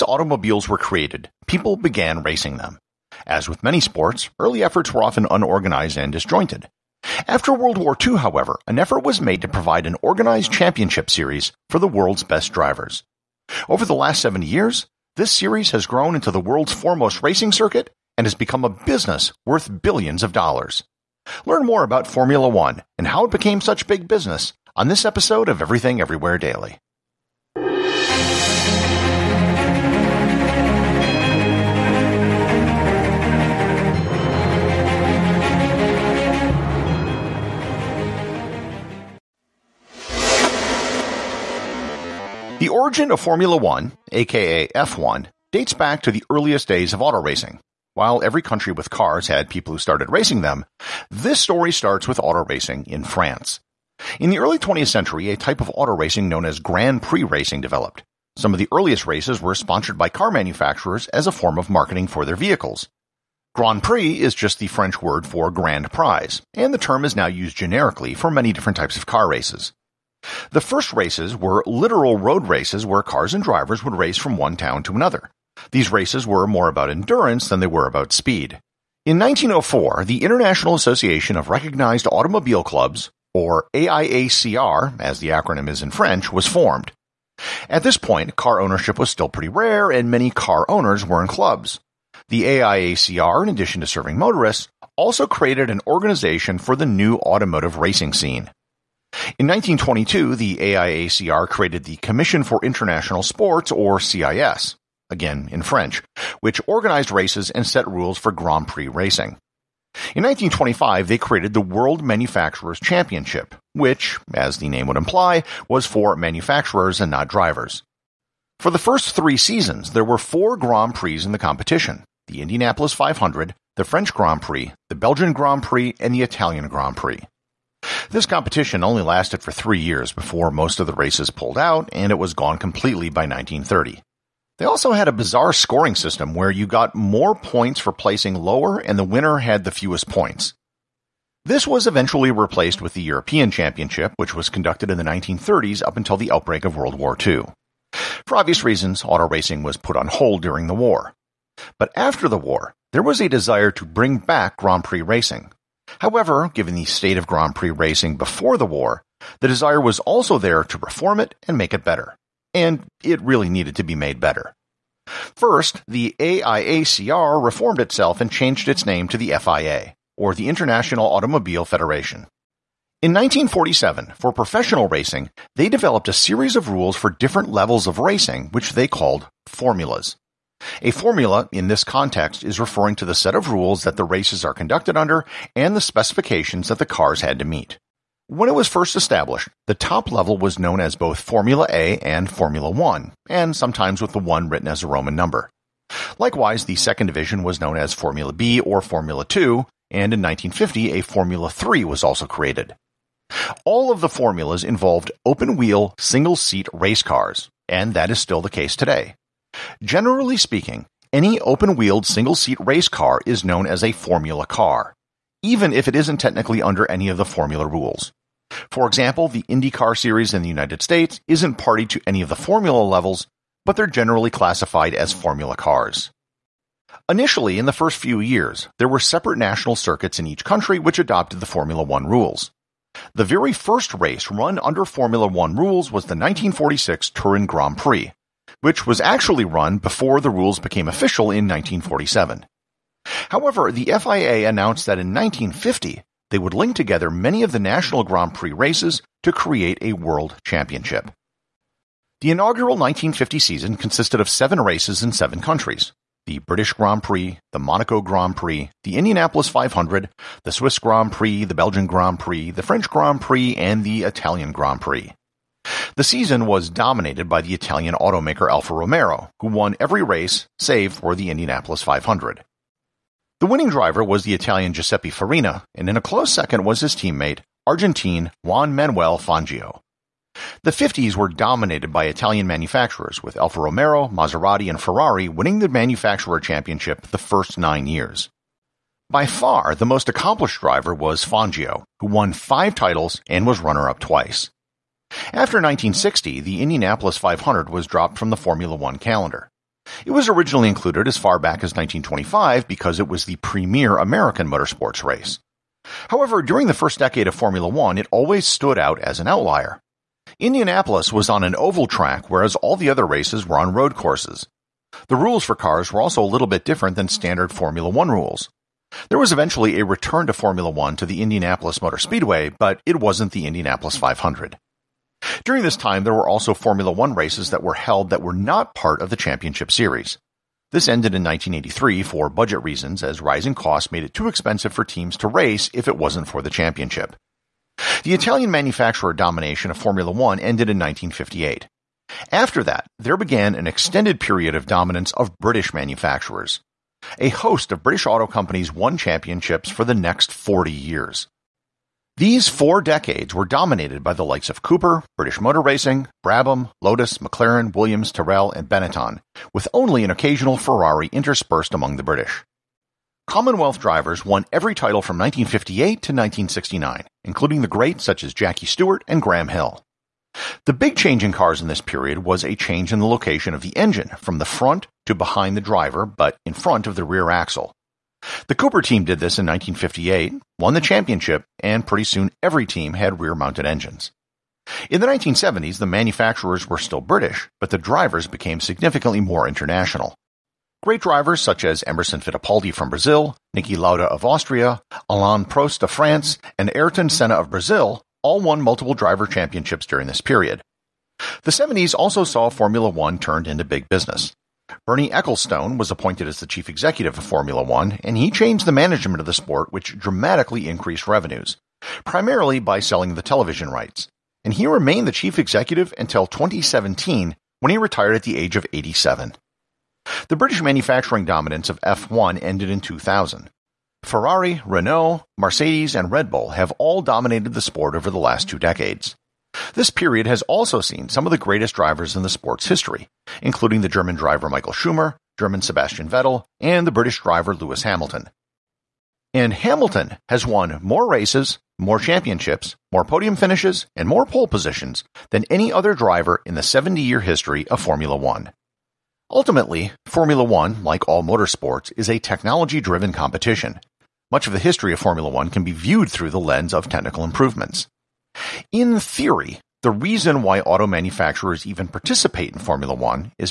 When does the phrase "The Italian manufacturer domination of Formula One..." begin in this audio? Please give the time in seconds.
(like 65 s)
338 s.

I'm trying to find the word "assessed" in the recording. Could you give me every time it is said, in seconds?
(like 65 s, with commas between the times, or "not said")
not said.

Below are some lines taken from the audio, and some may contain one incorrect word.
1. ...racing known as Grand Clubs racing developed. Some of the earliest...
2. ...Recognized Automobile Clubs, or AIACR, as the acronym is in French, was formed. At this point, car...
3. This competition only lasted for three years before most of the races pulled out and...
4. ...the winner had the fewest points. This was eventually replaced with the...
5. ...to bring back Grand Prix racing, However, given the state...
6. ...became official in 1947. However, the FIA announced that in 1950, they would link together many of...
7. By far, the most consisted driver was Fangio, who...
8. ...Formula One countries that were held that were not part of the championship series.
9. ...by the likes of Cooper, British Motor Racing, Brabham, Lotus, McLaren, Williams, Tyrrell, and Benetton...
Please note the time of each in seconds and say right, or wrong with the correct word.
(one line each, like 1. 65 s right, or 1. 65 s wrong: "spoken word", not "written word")
1. 55 s wrong: "Prix", not "Clubs"
2. 81 s right
3. 128 s right
4. 138 s right
5. 153 s right
6. 240 s right
7. 289 s wrong: "accomplished", not "consisted"
8. 326 s wrong: "races", not "countries"
9. 354 s right.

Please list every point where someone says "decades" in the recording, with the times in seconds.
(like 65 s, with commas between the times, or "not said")
306 s, 352 s, 428 s.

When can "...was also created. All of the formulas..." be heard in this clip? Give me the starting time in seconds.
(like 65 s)
201 s.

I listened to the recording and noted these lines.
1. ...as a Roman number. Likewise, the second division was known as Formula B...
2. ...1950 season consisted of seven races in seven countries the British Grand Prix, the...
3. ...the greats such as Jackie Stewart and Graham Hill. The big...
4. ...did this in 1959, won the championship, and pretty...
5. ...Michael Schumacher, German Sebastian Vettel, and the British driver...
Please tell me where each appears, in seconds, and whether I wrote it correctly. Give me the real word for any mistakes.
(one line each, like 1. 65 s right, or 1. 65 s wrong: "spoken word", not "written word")
1. 194 s right
2. 252 s right
3. 367 s right
4. 379 s wrong: "1958", not "1959"
5. 434 s right.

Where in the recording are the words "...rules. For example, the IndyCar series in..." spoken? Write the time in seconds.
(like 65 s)
217 s.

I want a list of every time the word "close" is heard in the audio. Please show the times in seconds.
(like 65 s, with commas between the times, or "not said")
276 s.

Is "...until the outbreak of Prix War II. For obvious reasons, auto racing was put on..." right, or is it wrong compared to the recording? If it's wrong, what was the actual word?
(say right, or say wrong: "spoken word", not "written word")
wrong: "World", not "Prix".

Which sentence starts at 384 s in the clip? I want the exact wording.
In the 1970s, the manufacturers were still British, but the drivers became significantly more international.